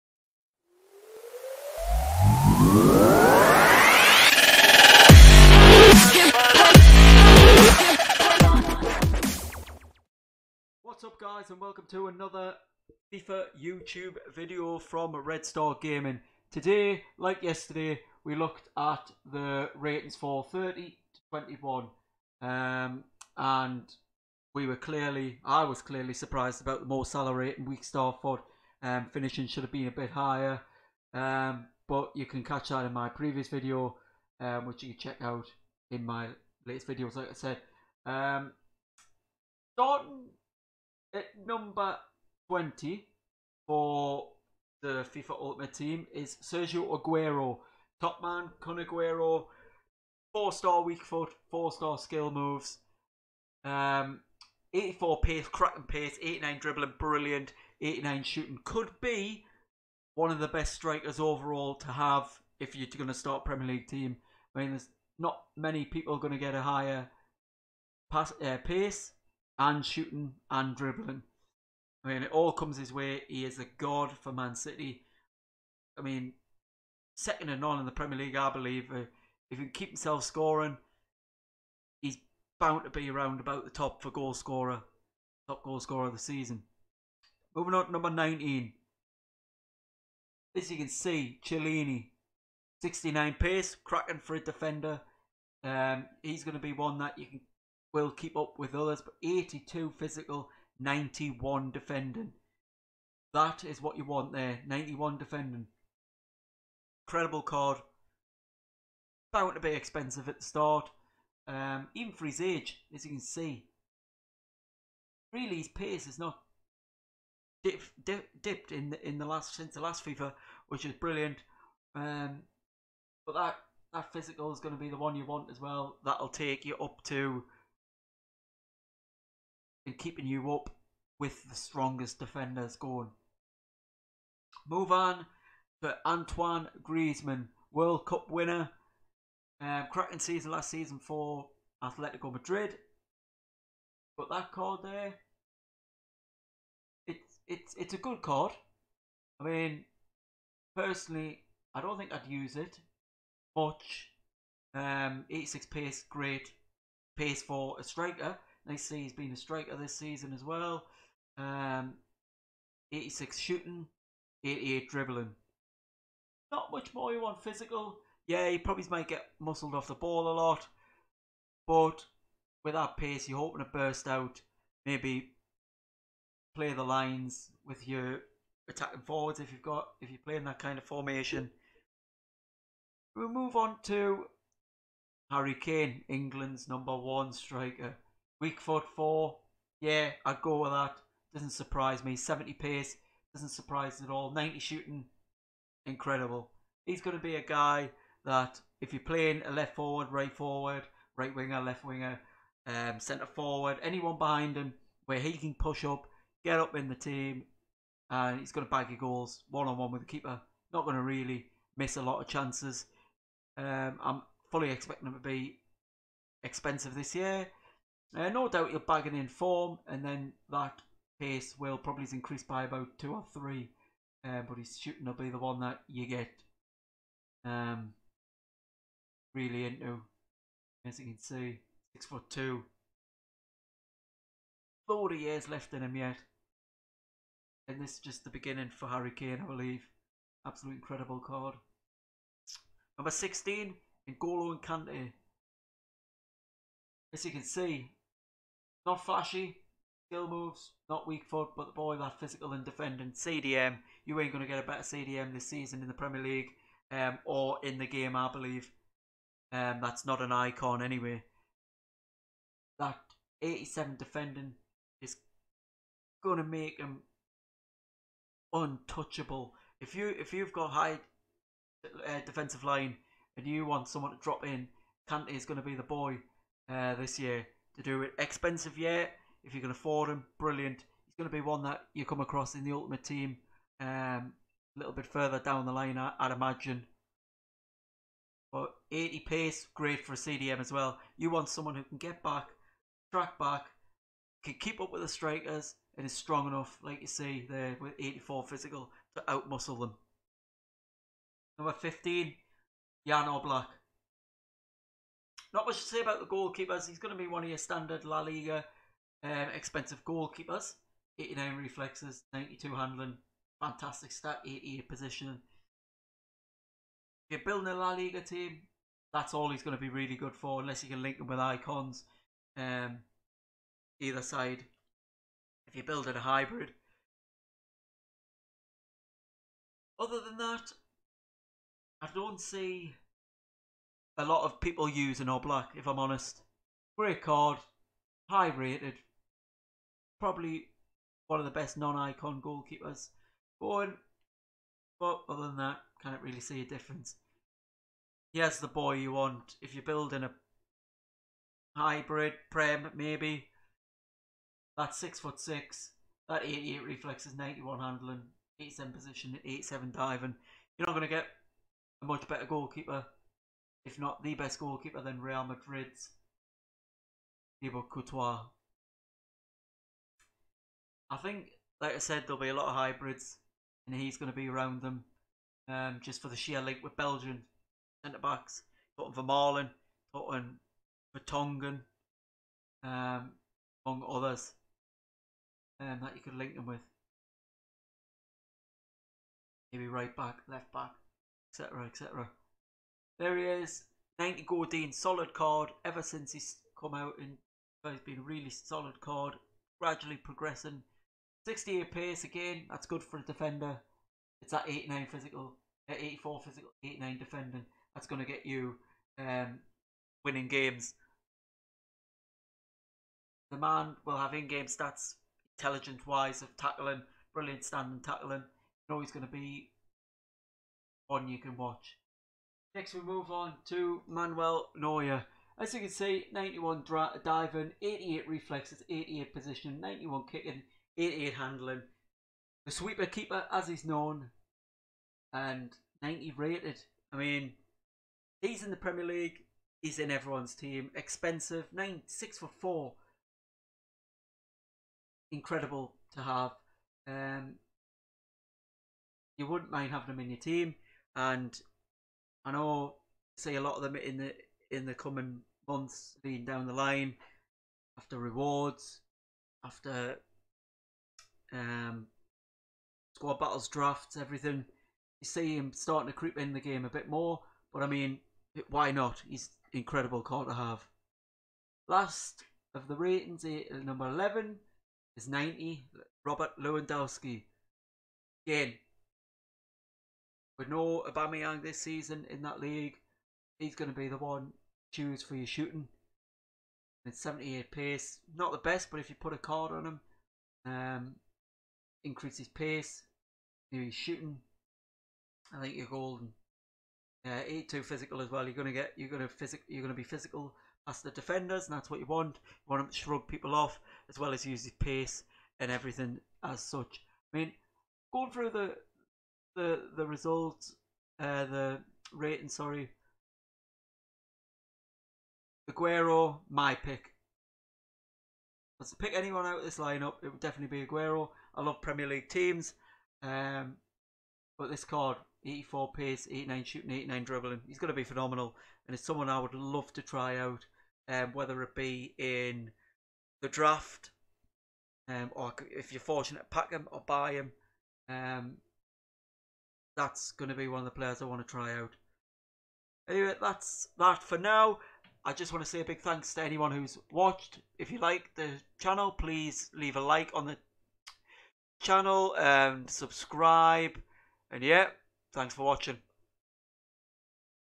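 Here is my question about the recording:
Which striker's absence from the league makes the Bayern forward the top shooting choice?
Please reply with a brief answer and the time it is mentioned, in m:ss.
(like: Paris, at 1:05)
Aubameyang, at 8:01.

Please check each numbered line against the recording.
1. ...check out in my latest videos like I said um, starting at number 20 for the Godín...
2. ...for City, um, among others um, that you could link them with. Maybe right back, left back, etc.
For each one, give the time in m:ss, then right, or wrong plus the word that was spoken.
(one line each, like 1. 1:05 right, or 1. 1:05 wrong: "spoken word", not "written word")
1. 0:35 wrong: "FIFA", not "Godín"
2. 6:21 wrong: "Tongan", not "City".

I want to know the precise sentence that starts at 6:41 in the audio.
68 pace again, that's good for a defender.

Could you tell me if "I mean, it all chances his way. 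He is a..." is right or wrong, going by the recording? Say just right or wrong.
wrong.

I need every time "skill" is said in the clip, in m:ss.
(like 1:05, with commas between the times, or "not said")
0:51, 4:10.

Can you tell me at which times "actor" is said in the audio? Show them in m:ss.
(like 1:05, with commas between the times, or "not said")
not said.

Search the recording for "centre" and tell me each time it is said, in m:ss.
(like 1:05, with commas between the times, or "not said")
3:22, 6:18.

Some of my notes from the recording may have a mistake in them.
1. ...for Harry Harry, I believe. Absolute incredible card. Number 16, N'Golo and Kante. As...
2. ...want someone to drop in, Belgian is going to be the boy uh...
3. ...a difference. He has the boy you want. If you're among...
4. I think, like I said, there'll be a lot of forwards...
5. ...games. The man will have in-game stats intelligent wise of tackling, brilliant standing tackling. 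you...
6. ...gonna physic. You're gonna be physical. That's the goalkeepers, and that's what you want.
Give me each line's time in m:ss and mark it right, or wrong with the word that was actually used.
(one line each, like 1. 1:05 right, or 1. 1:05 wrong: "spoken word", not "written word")
1. 3:58 wrong: "Kane", not "Harry"
2. 4:33 wrong: "Kante", not "Belgian"
3. 5:46 wrong: "building", not "among"
4. 6:11 wrong: "hybrids", not "forwards"
5. 6:50 right
6. 8:19 wrong: "defenders", not "goalkeepers".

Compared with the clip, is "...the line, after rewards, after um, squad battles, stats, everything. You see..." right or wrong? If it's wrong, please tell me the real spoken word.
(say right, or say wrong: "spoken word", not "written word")
wrong: "drafts", not "stats".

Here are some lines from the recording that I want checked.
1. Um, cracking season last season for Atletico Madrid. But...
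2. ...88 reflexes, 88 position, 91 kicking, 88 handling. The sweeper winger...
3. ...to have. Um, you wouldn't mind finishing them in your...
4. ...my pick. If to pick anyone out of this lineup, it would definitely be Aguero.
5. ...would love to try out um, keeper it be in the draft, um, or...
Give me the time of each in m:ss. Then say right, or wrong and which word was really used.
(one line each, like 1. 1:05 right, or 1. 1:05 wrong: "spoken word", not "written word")
1. 2:19 right
2. 7:07 wrong: "keeper", not "winger"
3. 7:26 wrong: "having", not "finishing"
4. 8:36 right
5. 8:49 wrong: "whether", not "keeper".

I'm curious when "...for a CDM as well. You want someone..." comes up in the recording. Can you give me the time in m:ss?
4:50.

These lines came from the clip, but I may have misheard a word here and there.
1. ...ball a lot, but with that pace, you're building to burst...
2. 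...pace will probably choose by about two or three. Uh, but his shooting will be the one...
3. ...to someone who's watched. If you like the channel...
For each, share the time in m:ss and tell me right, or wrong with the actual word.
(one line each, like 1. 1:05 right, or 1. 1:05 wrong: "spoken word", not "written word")
1. 2:49 wrong: "hoping", not "building"
2. 3:41 wrong: "increase", not "choose"
3. 9:06 wrong: "anyone", not "someone".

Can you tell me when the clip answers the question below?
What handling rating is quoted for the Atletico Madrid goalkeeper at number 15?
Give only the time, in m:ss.
5:12.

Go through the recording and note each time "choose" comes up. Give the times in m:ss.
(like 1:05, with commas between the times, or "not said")
8:04.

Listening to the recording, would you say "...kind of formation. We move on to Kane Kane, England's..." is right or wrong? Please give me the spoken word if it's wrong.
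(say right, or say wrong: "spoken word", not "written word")
wrong: "Harry", not "Kane".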